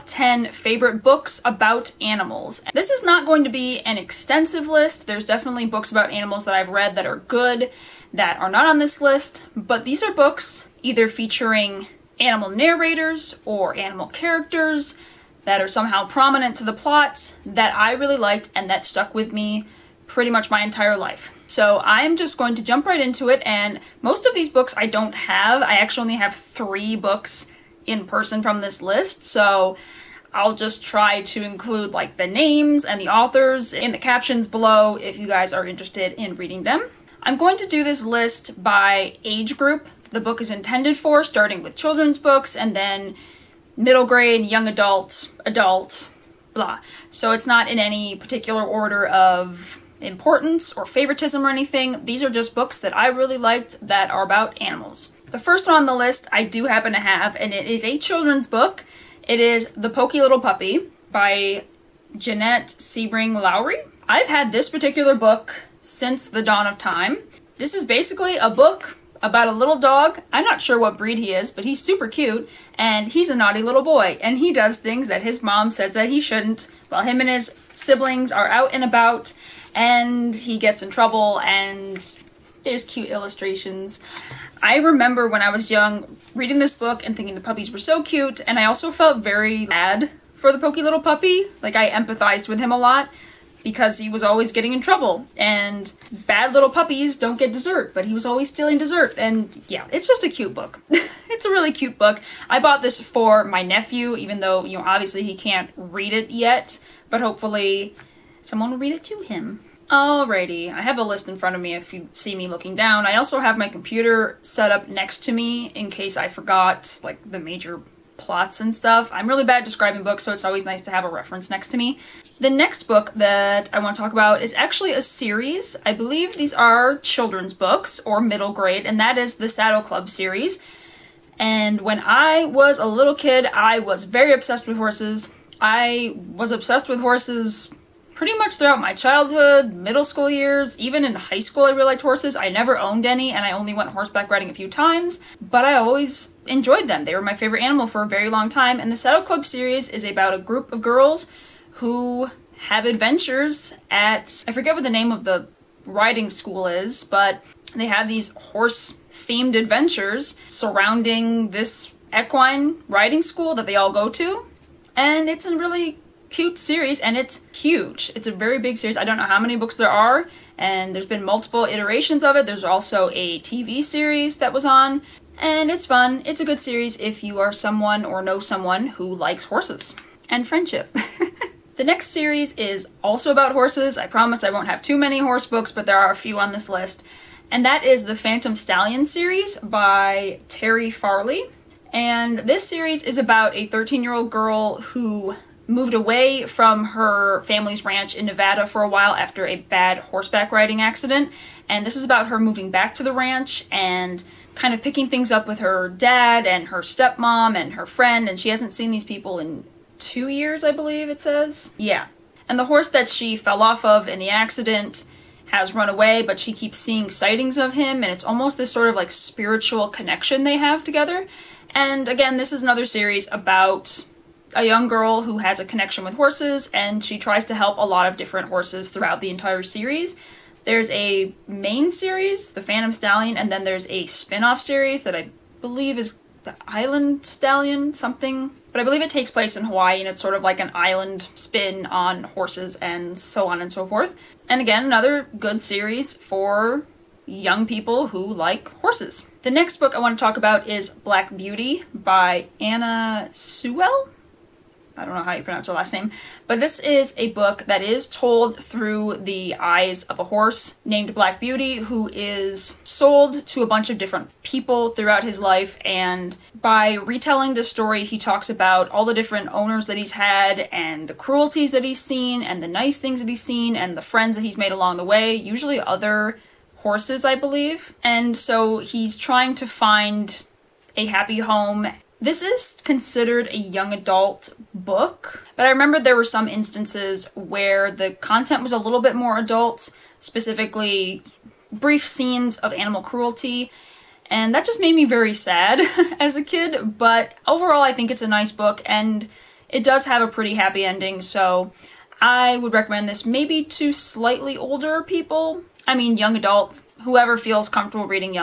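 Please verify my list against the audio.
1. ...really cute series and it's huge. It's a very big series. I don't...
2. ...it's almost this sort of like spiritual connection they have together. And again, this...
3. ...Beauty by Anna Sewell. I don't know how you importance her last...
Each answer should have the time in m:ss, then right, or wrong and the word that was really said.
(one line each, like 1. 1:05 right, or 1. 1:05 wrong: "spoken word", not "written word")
1. 2:45 right
2. 3:38 right
3. 4:11 wrong: "pronounce", not "importance".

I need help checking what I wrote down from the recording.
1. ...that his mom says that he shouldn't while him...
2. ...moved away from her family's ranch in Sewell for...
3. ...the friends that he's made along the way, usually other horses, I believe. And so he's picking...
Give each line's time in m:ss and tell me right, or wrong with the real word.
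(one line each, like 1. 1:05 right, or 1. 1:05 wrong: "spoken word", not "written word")
1. 1:15 right
2. 3:15 wrong: "Nevada", not "Sewell"
3. 4:33 wrong: "trying", not "picking".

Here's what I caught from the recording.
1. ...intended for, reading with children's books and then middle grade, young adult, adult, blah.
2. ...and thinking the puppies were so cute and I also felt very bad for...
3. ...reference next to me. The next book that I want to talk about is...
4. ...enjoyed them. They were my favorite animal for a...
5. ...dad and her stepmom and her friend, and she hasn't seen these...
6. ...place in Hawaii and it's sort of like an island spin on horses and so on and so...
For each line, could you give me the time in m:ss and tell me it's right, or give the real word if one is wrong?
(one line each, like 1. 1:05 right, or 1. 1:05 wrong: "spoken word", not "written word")
1. 0:40 wrong: "starting", not "reading"
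2. 1:27 right
3. 2:01 right
4. 2:26 right
5. 3:25 right
6. 3:59 right.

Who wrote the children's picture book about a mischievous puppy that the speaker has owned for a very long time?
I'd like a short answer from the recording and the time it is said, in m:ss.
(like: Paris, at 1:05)
Janette Sebring Lowrey, at 1:02.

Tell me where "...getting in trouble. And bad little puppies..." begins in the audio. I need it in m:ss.
1:34.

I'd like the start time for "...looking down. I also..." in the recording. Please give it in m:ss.
1:52.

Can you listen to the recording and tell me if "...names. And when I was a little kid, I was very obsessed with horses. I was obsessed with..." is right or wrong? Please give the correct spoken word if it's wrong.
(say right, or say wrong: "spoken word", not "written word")
wrong: "series", not "names".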